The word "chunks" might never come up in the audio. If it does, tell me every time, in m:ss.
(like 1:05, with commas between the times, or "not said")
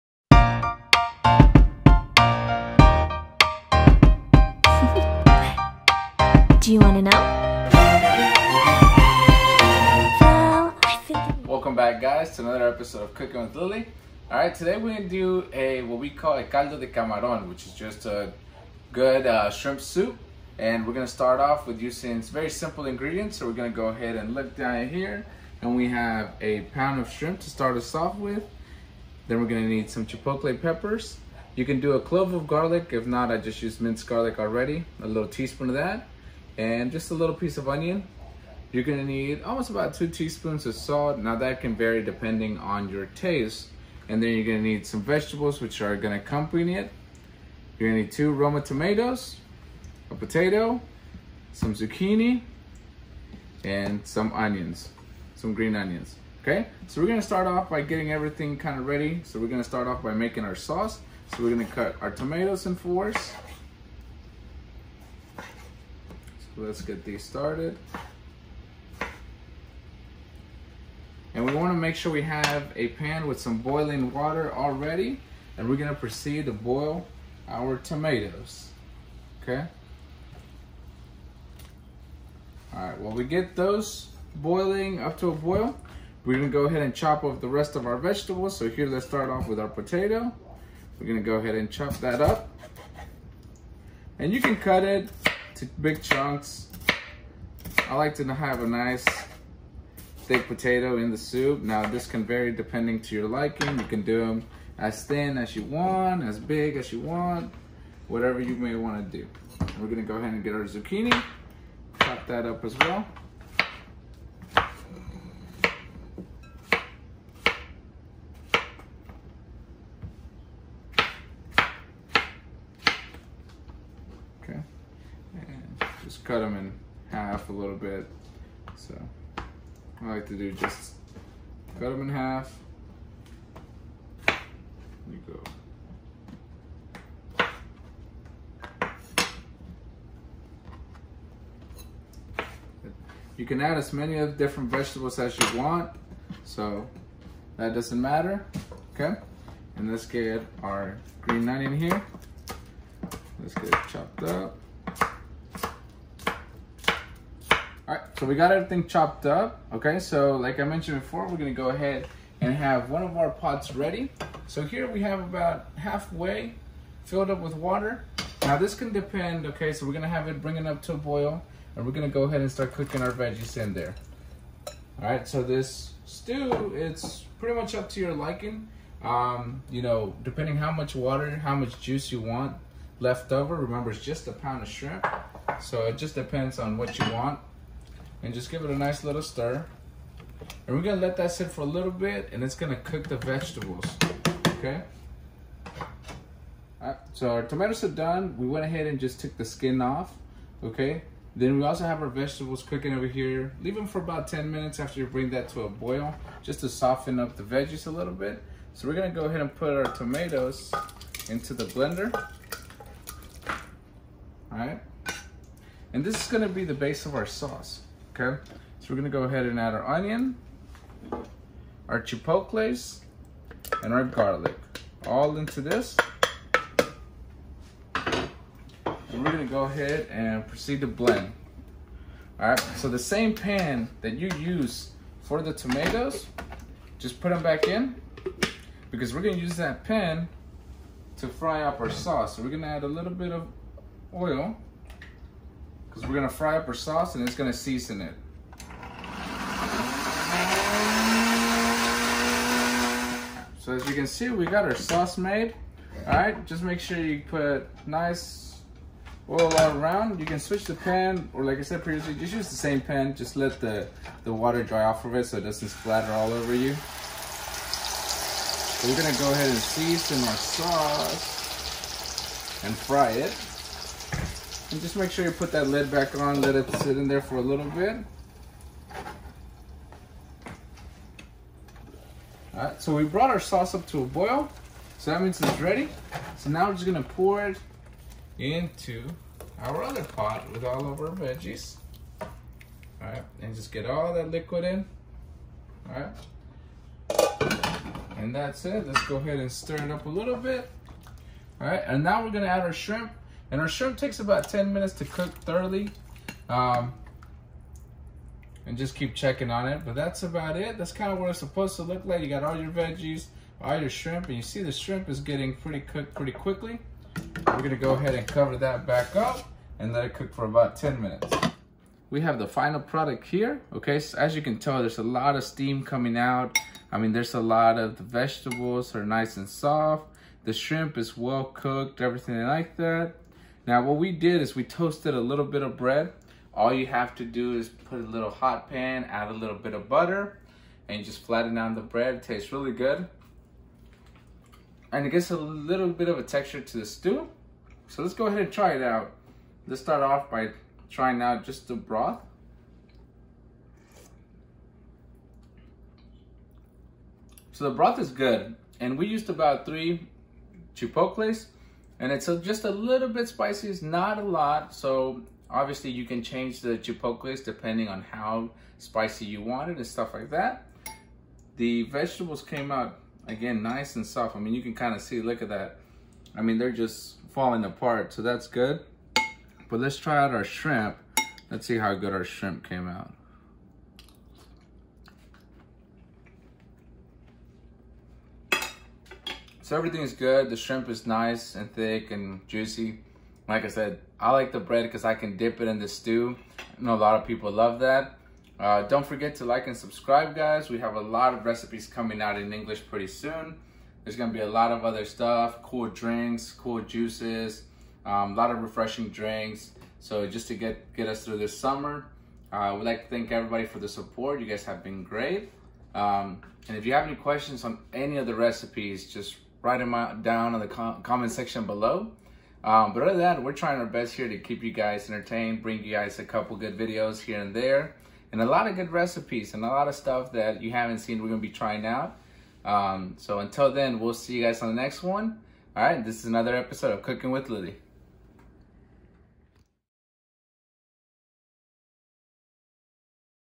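1:36.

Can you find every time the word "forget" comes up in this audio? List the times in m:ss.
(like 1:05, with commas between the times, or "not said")
6:39.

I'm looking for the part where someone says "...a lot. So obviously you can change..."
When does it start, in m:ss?
6:04.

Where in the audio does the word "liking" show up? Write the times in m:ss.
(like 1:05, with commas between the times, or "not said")
1:43, 2:58.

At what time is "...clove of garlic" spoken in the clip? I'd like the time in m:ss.
0:31.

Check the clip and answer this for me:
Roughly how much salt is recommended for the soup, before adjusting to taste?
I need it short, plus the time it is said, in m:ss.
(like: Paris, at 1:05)
2 teaspoons, at 0:39.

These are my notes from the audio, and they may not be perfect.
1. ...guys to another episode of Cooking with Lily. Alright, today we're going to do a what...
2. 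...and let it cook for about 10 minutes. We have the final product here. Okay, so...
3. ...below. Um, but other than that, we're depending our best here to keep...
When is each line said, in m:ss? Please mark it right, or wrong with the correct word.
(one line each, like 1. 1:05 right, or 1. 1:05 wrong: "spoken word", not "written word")
1. 0:11 right
2. 5:19 right
3. 7:01 wrong: "trying", not "depending".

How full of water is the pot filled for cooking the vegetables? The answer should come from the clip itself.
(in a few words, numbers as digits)
about halfway.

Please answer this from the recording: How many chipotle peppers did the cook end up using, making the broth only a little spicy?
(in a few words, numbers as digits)
3.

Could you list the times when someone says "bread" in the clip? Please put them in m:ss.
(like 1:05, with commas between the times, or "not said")
5:35, 5:41, 6:34.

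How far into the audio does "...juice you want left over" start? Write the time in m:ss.
3:01.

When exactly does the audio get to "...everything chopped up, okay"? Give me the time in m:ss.
2:38.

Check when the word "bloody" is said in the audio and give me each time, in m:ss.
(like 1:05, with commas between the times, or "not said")
not said.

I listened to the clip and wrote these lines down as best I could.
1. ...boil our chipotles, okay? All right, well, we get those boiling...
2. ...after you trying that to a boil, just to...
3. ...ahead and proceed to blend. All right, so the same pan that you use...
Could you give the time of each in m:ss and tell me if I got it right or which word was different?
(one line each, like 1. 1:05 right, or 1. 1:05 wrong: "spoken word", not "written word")
1. 1:16 wrong: "tomatoes", not "chipotles"
2. 3:24 wrong: "bring", not "trying"
3. 3:49 right.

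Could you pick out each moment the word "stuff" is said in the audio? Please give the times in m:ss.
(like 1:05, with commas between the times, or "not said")
6:09, 6:45, 7:09.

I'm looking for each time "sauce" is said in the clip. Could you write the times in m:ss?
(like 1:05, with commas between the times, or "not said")
1:00, 3:37, 4:01, 4:06, 4:14, 4:30, 4:43.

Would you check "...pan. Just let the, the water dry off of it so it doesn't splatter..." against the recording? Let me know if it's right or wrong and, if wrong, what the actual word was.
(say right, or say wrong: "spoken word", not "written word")
right.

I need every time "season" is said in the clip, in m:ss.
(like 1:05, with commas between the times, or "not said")
4:07, 4:29.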